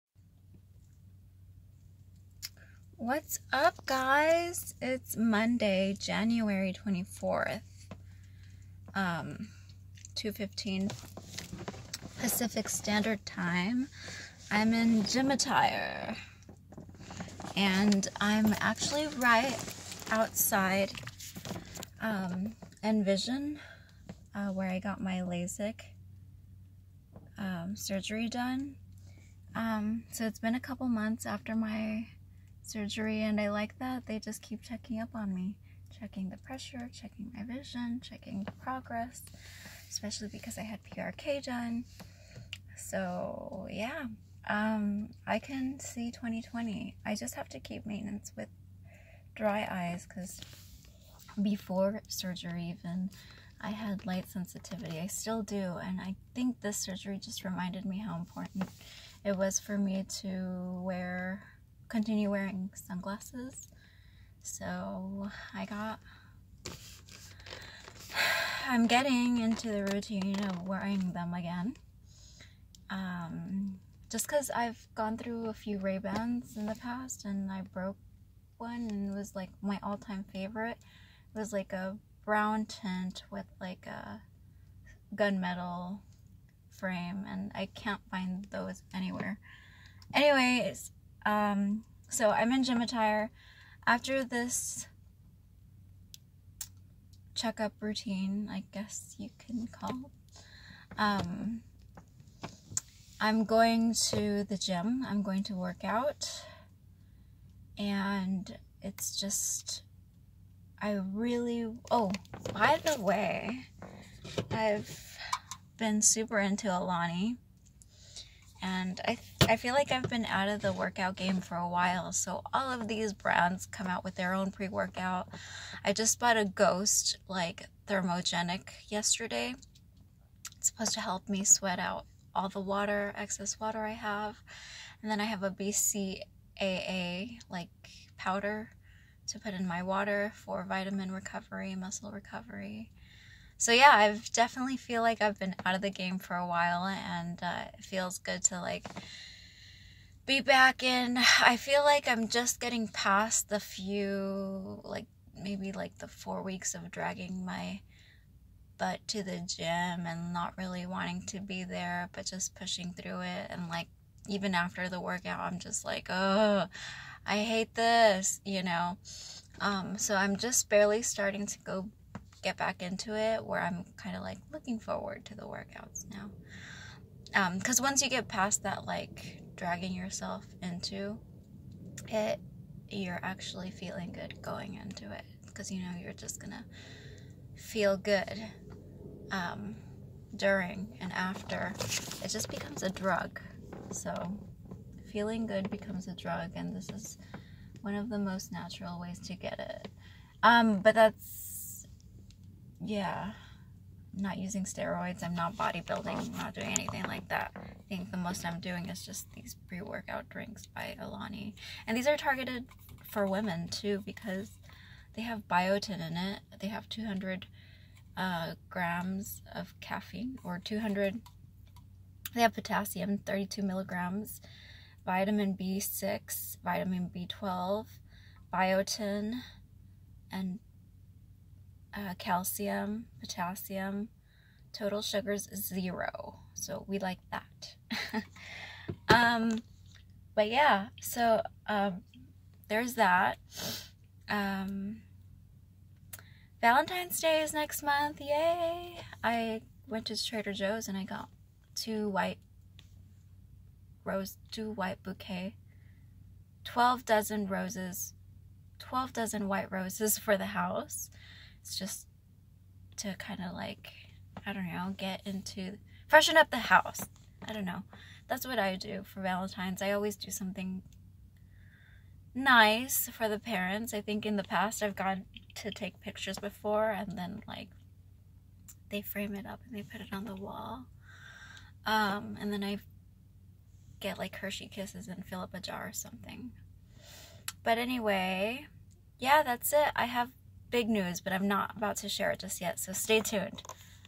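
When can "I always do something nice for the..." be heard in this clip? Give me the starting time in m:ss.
4:29.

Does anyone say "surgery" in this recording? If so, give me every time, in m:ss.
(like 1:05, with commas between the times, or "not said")
0:27, 0:32, 0:52, 0:56.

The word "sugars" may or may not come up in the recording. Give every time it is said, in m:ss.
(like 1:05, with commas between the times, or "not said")
3:55.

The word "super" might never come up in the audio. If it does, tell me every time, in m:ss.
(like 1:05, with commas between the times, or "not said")
1:56.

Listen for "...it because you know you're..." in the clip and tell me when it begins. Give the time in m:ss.
3:05.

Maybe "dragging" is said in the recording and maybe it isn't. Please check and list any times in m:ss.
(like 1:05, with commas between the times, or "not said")
2:36, 2:59.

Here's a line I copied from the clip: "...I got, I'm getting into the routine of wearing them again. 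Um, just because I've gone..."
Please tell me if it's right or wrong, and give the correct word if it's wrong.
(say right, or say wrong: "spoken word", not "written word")
right.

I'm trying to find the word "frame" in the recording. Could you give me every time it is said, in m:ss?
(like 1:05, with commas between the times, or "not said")
1:26, 4:39.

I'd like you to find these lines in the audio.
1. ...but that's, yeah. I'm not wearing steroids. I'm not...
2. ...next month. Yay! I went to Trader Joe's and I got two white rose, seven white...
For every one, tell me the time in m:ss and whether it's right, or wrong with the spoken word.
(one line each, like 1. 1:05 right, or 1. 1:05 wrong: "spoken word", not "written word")
1. 3:20 wrong: "using", not "wearing"
2. 4:07 wrong: "two", not "seven".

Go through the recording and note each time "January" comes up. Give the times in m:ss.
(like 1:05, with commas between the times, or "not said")
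0:05.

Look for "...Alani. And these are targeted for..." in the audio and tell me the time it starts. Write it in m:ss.
3:30.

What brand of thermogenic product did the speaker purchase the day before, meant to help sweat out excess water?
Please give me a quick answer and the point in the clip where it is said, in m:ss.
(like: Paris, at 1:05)
Ghost, at 2:06.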